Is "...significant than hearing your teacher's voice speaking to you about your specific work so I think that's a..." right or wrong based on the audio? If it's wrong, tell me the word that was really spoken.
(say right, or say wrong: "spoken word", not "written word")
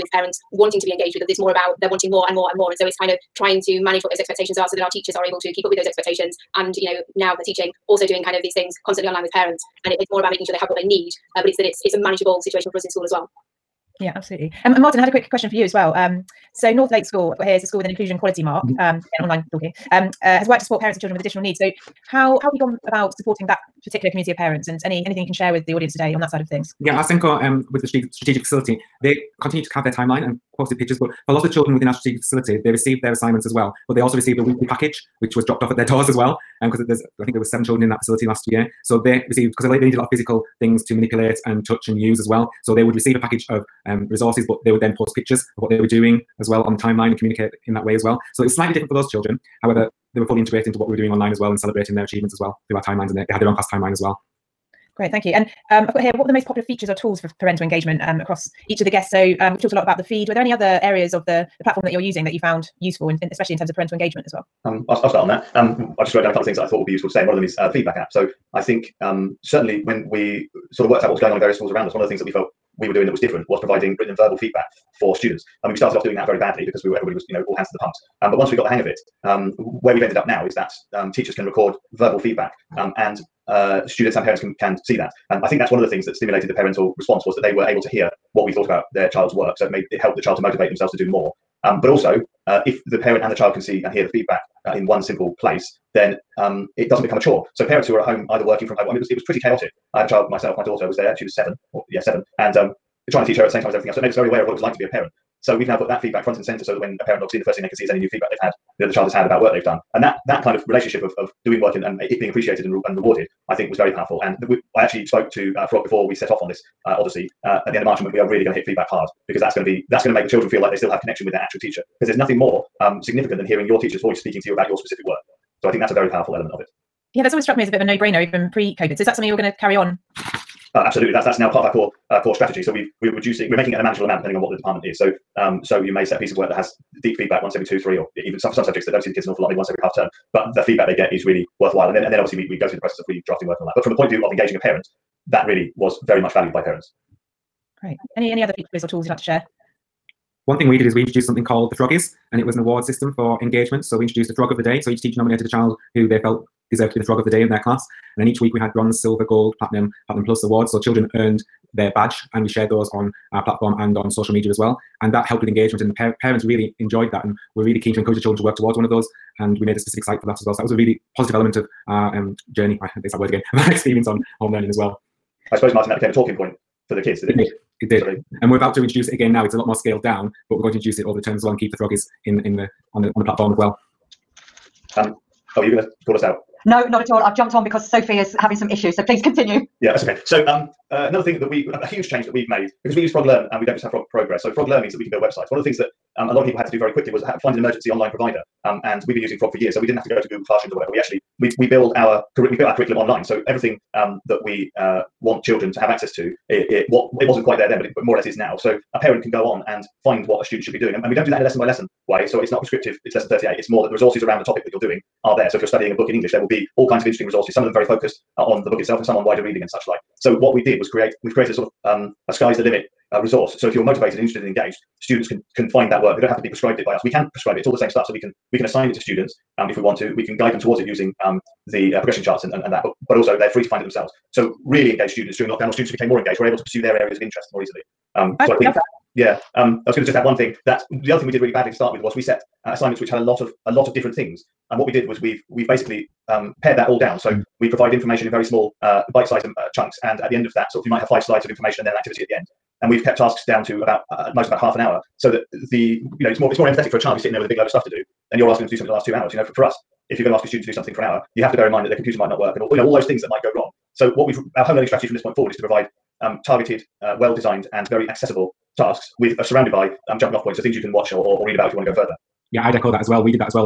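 right.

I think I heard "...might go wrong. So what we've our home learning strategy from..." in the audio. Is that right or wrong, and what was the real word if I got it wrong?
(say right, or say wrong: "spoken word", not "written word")
right.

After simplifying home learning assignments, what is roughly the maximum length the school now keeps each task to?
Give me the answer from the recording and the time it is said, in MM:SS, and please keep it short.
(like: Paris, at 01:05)
half an hour, at 04:14.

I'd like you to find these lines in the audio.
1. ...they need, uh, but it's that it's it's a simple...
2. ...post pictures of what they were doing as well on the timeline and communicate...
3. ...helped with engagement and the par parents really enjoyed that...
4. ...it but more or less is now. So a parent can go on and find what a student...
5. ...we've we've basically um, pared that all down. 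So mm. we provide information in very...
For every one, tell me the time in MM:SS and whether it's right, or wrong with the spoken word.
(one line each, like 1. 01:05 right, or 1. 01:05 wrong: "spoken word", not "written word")
1. 00:10 wrong: "manageable", not "simple"
2. 00:44 right
3. 02:45 right
4. 03:27 right
5. 04:05 right.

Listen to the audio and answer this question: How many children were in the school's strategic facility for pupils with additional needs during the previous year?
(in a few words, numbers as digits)
7.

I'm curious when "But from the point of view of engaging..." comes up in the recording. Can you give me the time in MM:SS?
02:23.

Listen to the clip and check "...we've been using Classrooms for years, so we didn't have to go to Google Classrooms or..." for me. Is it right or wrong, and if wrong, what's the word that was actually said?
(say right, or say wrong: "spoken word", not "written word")
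wrong: "Frog", not "Classrooms".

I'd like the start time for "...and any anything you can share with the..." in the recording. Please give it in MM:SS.
00:24.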